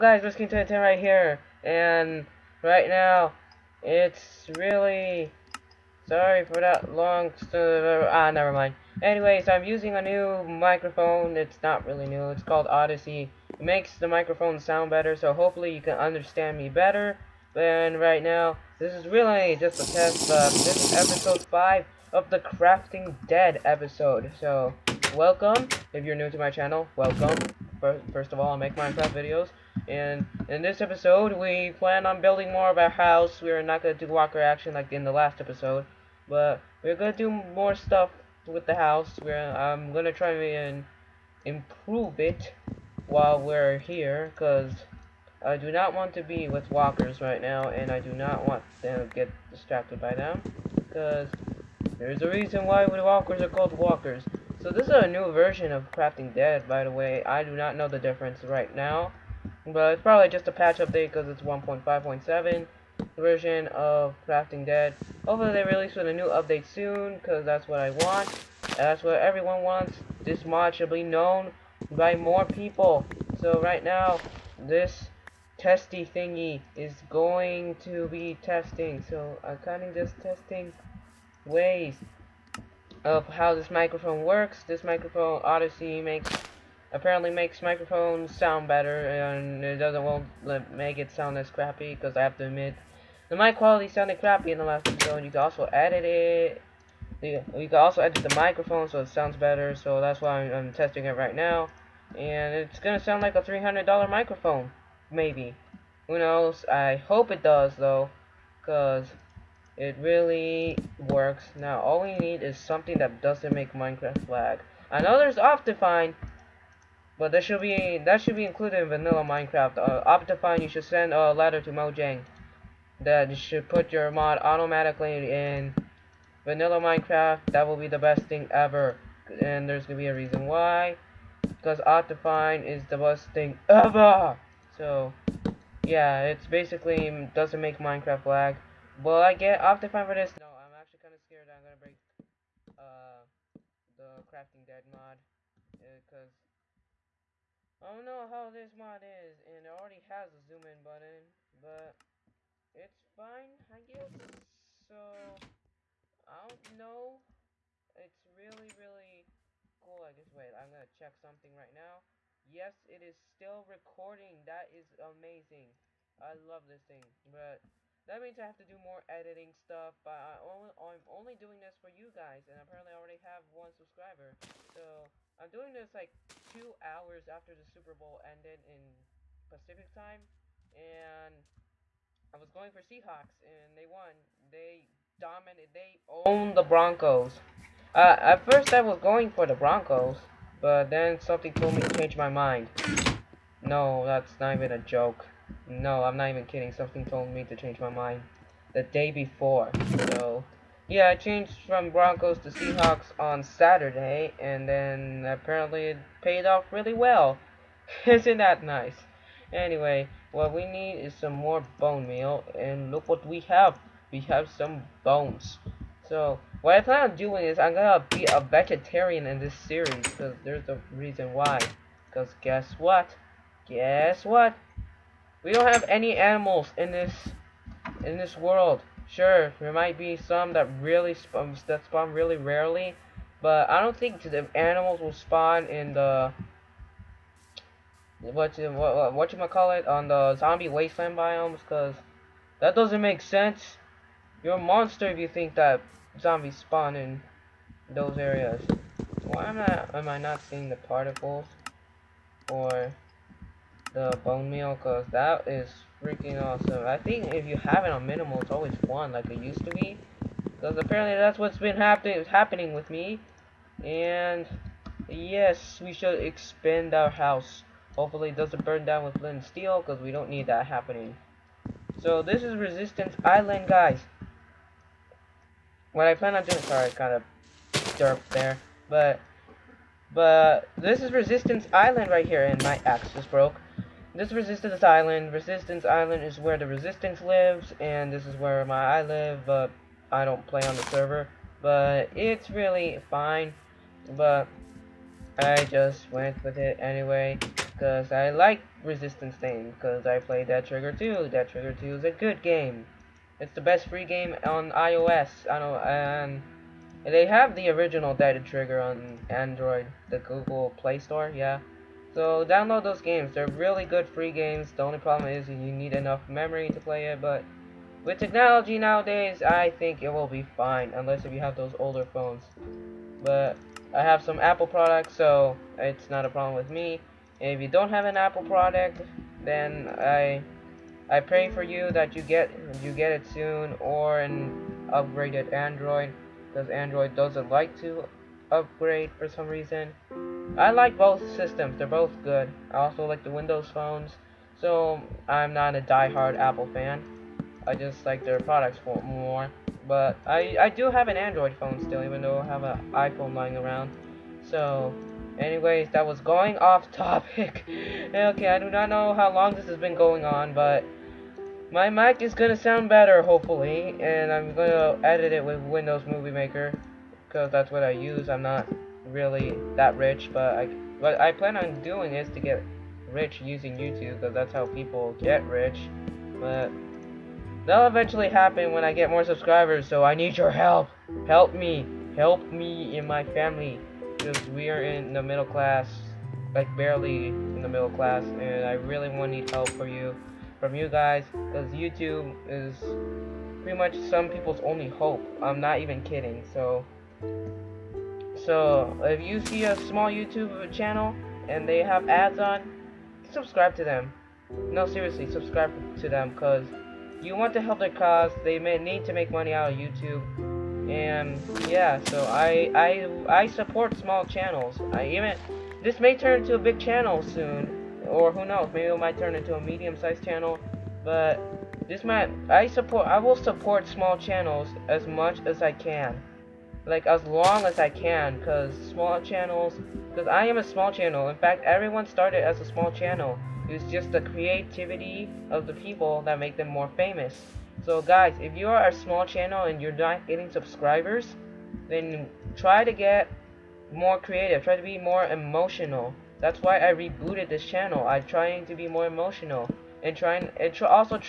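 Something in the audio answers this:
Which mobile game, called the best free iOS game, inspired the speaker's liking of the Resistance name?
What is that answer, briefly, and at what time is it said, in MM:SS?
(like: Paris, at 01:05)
Dead Trigger 2, at 05:01.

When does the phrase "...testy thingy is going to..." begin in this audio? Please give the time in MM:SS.
01:15.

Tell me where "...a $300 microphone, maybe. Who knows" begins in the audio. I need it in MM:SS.
01:43.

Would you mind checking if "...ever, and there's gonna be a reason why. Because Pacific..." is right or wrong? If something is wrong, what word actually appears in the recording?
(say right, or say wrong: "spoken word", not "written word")
wrong: "Optifine", not "Pacific".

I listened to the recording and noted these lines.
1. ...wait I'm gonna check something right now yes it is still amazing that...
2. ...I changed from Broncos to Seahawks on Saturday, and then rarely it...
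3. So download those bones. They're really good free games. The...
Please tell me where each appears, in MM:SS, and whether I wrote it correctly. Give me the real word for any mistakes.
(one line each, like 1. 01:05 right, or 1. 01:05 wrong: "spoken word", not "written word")
1. 02:40 wrong: "recording", not "amazing"
2. 03:21 wrong: "apparently", not "rarely"
3. 05:12 wrong: "games", not "bones".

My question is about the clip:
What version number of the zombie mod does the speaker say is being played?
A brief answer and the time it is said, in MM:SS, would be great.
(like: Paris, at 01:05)
1.5.7, at 01:01.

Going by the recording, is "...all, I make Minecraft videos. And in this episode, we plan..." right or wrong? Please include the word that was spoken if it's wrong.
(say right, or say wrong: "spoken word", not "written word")
right.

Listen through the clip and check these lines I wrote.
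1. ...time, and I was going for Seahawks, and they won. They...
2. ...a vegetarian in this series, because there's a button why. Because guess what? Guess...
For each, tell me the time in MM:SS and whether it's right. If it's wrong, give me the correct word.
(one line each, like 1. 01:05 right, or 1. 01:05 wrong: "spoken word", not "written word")
1. 02:59 right
2. 03:38 wrong: "reason", not "button".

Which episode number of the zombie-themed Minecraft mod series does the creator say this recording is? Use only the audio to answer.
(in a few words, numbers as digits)
5.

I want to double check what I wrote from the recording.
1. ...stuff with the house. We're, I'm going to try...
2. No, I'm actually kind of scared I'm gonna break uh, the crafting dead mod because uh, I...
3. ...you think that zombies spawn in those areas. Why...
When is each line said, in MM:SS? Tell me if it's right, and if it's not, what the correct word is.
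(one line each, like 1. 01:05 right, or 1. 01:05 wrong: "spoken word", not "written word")
1. 00:37 right
2. 02:20 right
3. 04:05 right.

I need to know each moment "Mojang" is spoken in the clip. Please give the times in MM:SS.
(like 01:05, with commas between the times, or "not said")
02:01.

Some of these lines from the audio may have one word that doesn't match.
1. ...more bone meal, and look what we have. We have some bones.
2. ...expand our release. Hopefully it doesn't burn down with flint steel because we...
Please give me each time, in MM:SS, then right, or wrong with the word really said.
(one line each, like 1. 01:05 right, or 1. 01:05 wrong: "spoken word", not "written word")
1. 03:31 right
2. 04:26 wrong: "house", not "release".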